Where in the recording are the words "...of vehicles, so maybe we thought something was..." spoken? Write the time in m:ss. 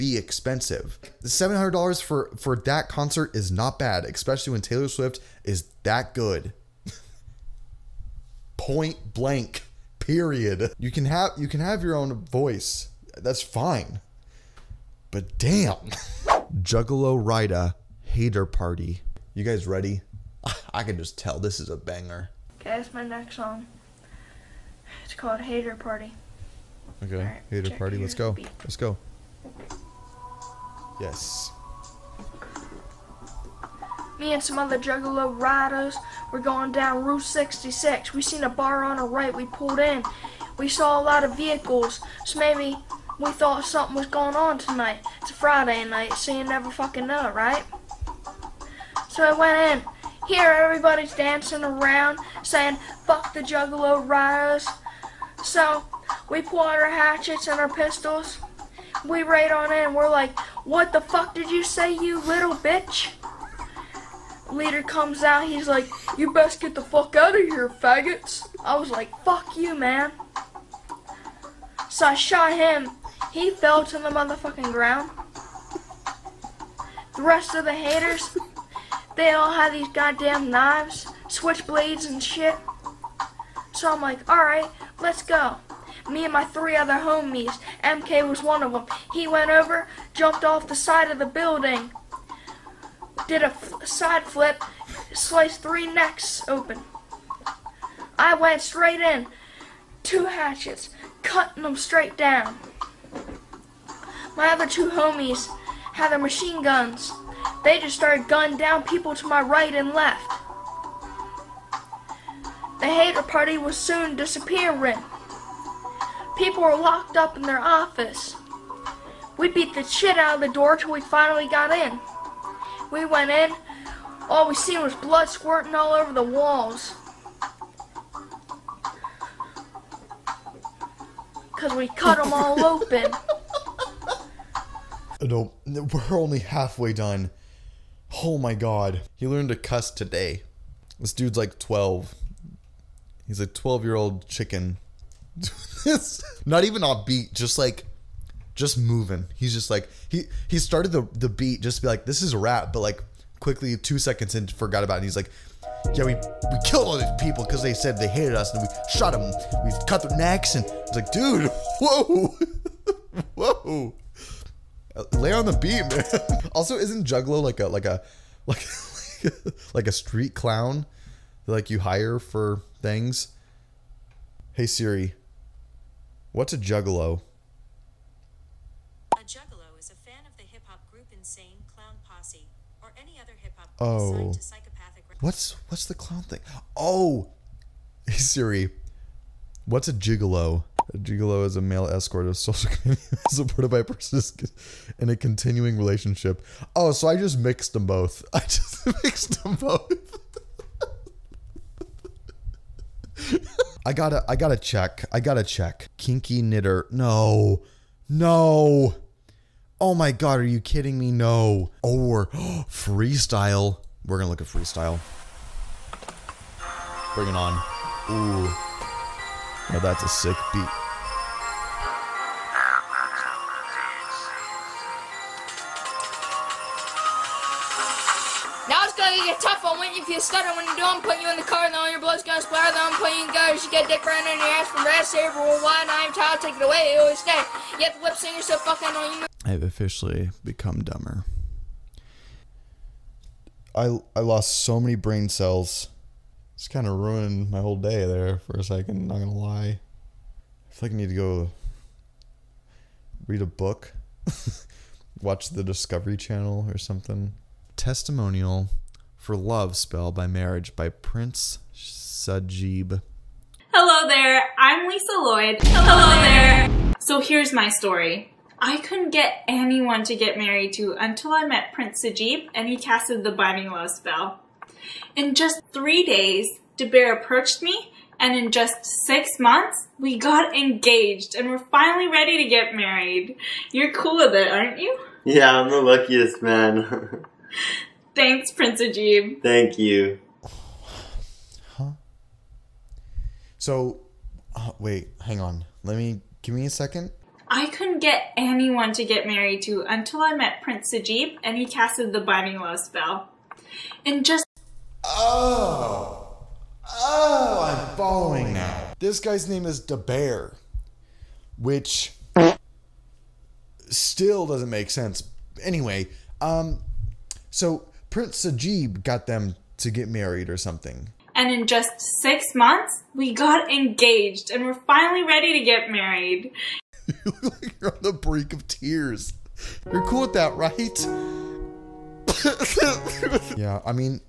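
0:41.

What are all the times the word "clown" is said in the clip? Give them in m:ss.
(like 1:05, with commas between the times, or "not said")
2:50, 3:01, 3:05.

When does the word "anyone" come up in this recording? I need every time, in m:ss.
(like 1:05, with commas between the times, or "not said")
4:29, 4:58.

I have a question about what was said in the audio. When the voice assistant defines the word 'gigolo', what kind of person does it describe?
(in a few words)
male escort.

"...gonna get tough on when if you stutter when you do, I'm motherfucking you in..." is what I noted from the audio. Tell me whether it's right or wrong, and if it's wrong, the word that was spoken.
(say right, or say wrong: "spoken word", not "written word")
wrong: "putting", not "motherfucking".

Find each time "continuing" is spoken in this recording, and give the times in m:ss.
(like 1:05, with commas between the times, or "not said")
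3:15.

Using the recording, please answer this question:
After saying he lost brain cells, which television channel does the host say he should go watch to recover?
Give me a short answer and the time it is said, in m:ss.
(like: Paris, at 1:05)
Discovery Channel, at 4:15.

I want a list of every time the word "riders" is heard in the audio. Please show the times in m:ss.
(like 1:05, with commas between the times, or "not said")
0:35, 0:54.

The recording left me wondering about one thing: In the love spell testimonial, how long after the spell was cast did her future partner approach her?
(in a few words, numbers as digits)
3 days.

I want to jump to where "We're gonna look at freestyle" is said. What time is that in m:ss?
3:34.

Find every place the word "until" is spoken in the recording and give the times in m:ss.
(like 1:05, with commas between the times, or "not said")
4:30, 4:59.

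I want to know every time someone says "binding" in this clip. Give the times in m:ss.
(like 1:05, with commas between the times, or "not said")
4:33, 5:02.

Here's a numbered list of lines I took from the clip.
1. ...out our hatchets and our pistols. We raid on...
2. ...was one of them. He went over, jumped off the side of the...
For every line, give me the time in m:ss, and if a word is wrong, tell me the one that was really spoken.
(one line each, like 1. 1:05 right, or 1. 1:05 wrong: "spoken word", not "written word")
1. 0:56 right
2. 1:28 right.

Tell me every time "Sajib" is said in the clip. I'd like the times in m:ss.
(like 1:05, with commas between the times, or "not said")
4:21, 4:32, 5:00, 5:18.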